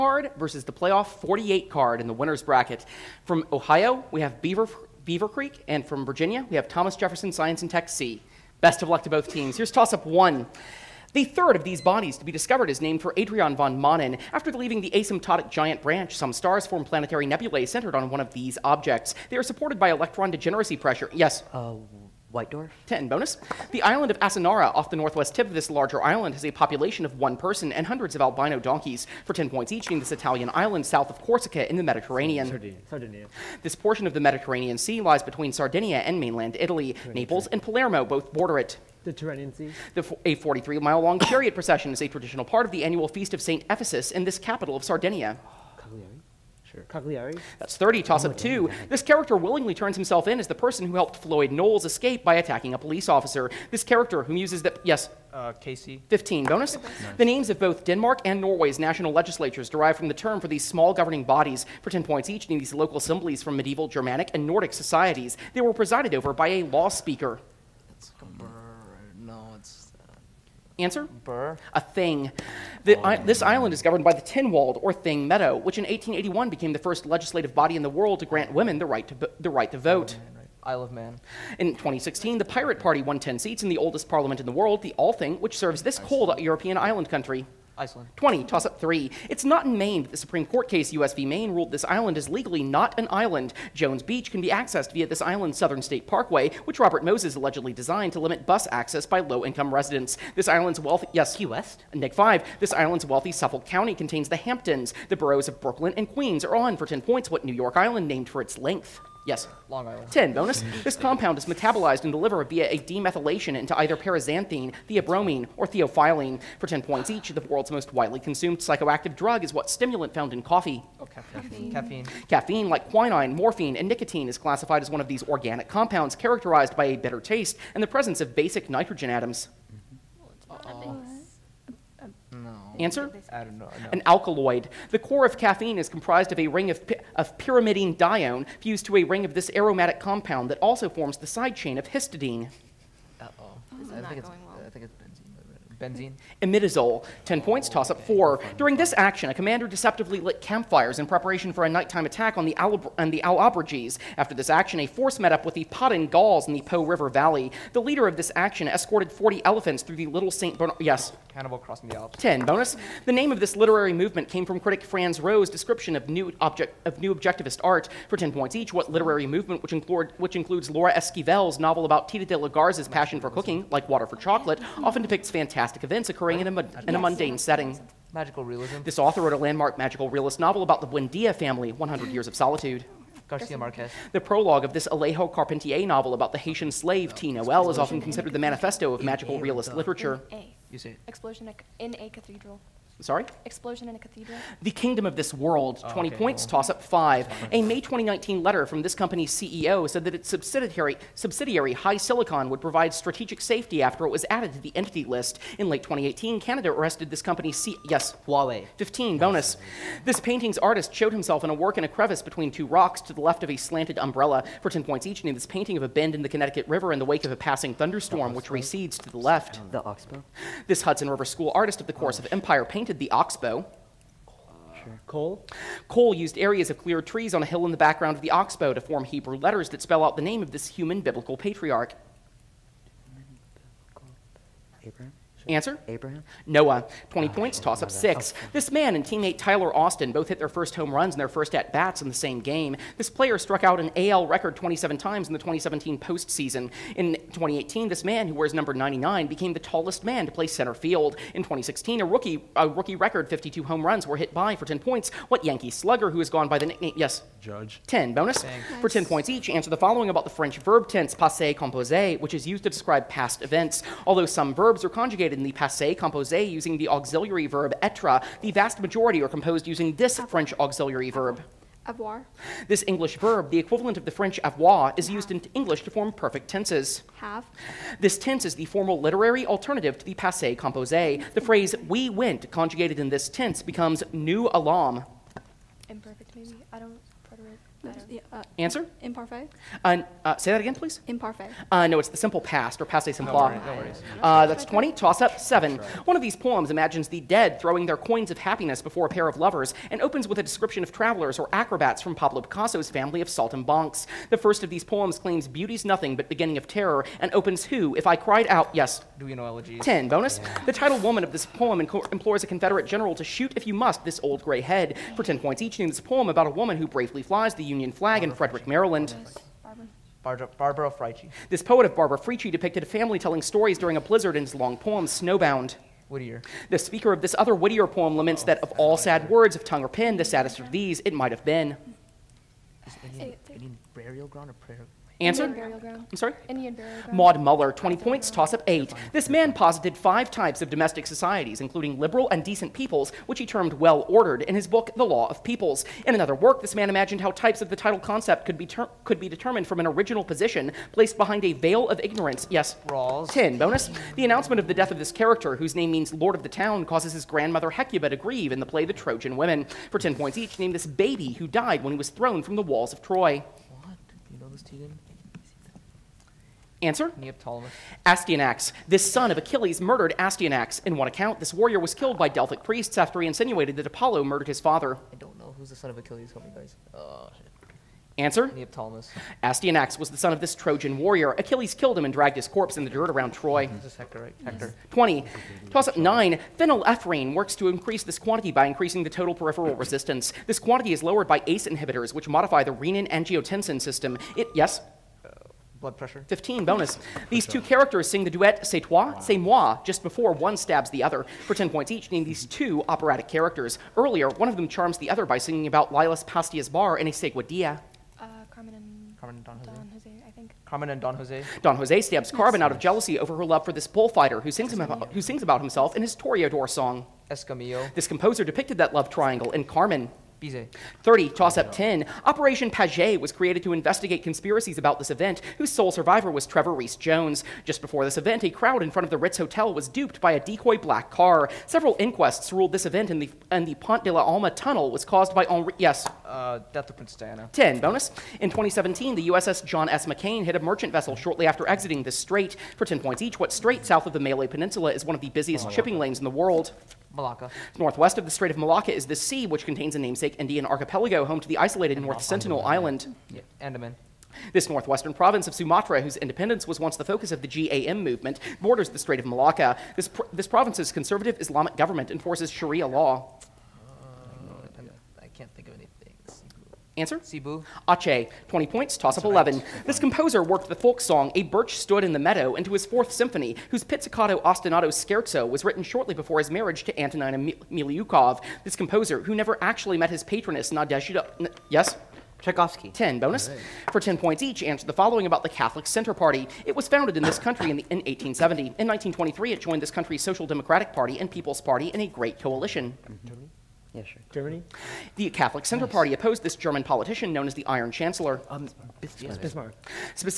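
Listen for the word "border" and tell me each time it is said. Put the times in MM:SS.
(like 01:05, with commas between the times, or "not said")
00:38, 07:38.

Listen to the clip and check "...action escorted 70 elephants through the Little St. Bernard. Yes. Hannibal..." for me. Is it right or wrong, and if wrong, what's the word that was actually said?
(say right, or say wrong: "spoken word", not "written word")
wrong: "40", not "70".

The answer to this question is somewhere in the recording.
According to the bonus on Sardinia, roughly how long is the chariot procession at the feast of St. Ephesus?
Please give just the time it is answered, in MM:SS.
00:40.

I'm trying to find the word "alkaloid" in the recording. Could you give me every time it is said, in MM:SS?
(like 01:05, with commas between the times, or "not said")
02:14.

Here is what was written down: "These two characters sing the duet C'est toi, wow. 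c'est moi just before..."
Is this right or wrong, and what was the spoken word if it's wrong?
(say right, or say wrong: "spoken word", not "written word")
right.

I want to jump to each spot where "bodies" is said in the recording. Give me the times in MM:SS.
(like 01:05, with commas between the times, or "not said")
00:11, 01:01.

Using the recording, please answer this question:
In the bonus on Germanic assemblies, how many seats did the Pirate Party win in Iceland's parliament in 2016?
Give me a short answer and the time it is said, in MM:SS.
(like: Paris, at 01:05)
10, at 01:23.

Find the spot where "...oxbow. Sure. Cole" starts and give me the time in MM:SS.
03:43.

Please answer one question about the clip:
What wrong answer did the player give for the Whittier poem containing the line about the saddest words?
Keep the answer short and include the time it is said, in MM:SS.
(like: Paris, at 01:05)
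Indian burial ground, at 05:36.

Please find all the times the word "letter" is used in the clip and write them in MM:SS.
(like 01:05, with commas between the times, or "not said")
03:18, 03:49.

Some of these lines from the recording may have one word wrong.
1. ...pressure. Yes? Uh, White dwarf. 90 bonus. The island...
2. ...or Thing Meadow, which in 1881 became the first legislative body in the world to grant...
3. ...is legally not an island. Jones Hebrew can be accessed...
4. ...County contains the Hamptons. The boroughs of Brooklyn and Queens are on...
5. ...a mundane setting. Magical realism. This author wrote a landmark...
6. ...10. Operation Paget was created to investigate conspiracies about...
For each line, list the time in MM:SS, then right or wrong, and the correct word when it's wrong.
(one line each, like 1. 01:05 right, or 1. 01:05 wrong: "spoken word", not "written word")
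1. 00:20 wrong: "10", not "90"
2. 01:14 right
3. 01:32 wrong: "Beach", not "Hebrew"
4. 01:43 right
5. 02:56 right
6. 07:01 right.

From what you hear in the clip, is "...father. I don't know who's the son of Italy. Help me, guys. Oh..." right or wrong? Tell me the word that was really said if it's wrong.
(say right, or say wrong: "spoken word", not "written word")
wrong: "Achilles", not "Italy".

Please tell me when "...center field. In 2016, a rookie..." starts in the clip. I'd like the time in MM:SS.
04:10.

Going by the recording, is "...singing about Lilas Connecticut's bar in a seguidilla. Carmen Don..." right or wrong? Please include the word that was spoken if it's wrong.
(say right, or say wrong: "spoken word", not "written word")
wrong: "Pastia", not "Connecticut".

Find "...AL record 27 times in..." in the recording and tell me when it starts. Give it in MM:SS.
04:03.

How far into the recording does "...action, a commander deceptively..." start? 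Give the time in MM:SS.
02:28.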